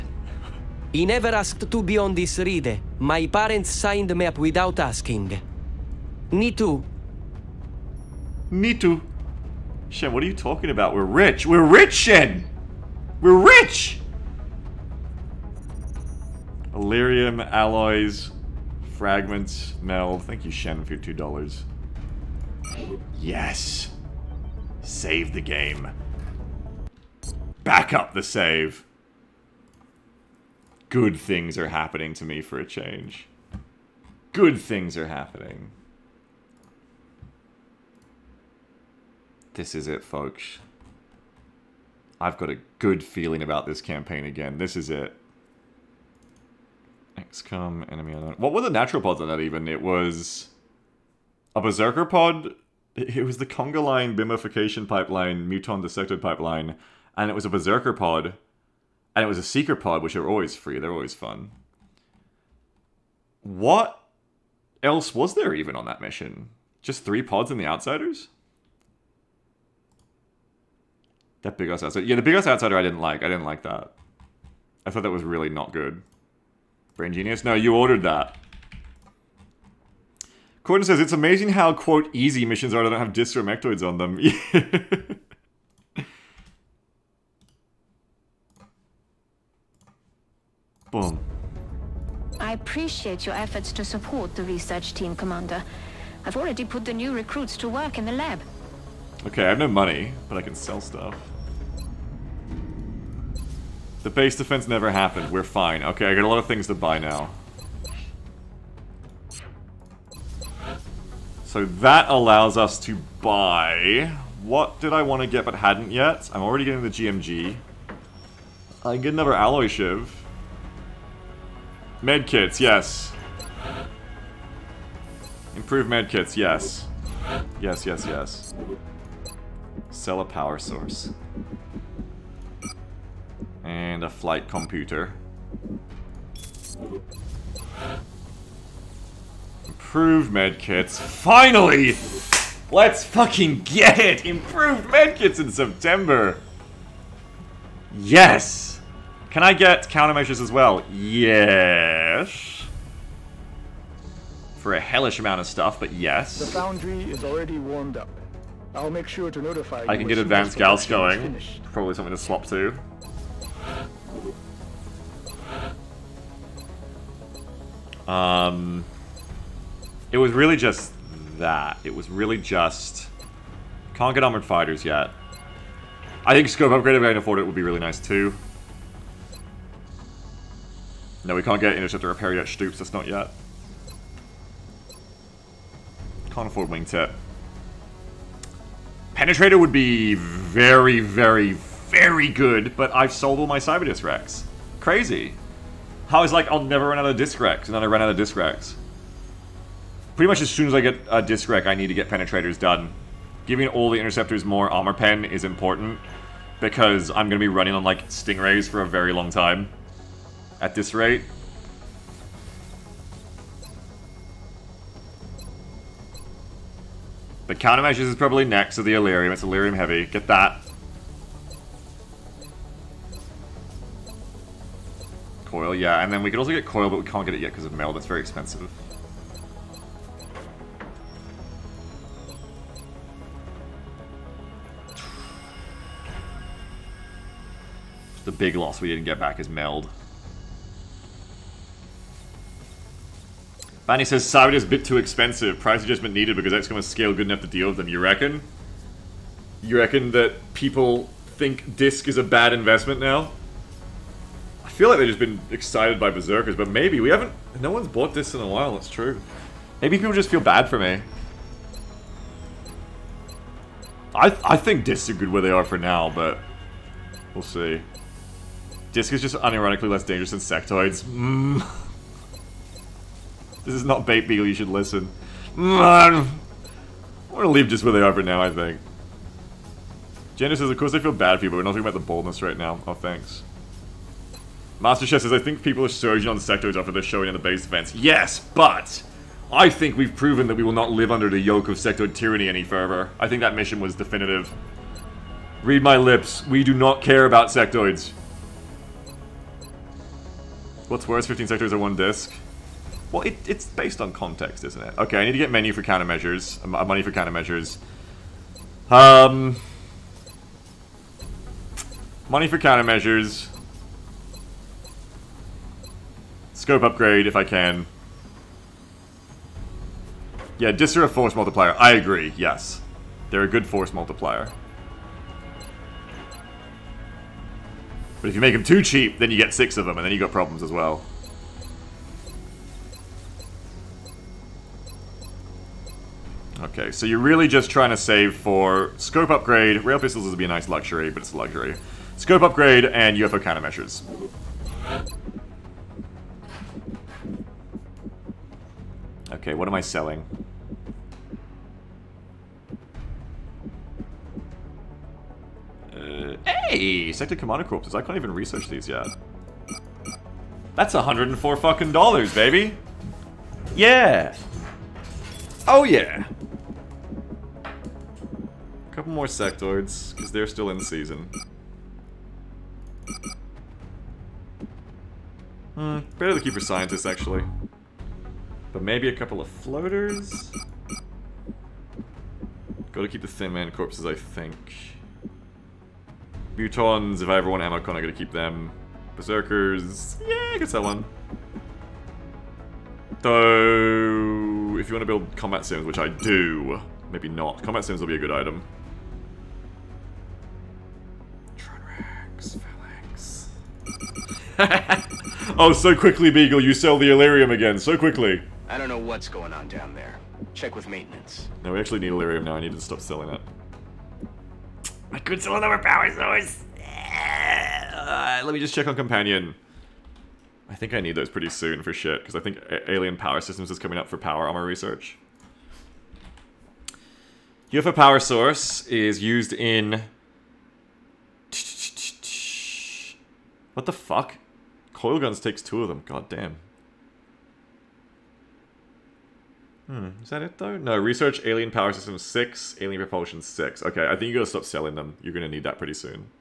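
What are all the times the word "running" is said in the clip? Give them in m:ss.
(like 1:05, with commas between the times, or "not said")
3:27.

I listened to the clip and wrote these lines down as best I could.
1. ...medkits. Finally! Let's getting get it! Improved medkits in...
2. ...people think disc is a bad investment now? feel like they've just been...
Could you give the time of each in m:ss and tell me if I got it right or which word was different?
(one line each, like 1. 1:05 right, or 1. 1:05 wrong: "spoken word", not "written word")
1. 2:20 wrong: "fucking", not "getting"
2. 4:10 right.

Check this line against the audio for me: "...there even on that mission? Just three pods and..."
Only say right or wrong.
right.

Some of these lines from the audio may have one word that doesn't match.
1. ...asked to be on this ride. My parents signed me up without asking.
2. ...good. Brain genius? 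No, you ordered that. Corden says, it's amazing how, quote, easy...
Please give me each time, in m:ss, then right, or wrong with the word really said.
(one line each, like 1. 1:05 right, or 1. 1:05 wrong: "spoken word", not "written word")
1. 0:01 right
2. 1:15 right.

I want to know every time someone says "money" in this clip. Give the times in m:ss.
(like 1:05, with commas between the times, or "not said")
1:39, 5:06, 5:12.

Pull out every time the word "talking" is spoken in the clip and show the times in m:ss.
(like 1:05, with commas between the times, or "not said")
0:10, 4:41.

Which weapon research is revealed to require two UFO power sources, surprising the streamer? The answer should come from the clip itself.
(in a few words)
Coil guns.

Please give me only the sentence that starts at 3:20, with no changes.
Pretty much as soon as I get a disc rack, I need to get penetrators done.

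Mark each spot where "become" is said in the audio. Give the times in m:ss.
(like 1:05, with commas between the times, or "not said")
not said.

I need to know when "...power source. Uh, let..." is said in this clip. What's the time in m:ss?
6:55.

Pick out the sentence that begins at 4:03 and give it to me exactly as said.
Fanny says is a bit too expensive.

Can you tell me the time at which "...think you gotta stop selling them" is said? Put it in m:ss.
7:24.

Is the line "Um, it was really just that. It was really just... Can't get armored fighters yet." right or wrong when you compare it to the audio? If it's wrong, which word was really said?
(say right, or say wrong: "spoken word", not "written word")
right.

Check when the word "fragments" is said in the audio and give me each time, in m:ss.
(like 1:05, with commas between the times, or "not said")
0:18.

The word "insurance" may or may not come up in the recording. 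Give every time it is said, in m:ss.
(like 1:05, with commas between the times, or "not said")
not said.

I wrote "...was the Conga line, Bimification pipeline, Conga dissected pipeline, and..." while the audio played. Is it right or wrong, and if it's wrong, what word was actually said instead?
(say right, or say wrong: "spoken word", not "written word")
wrong: "Muton", not "Conga".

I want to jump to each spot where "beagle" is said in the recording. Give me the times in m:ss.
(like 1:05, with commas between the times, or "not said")
4:34, 6:46.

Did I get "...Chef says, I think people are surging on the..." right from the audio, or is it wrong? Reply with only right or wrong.
right.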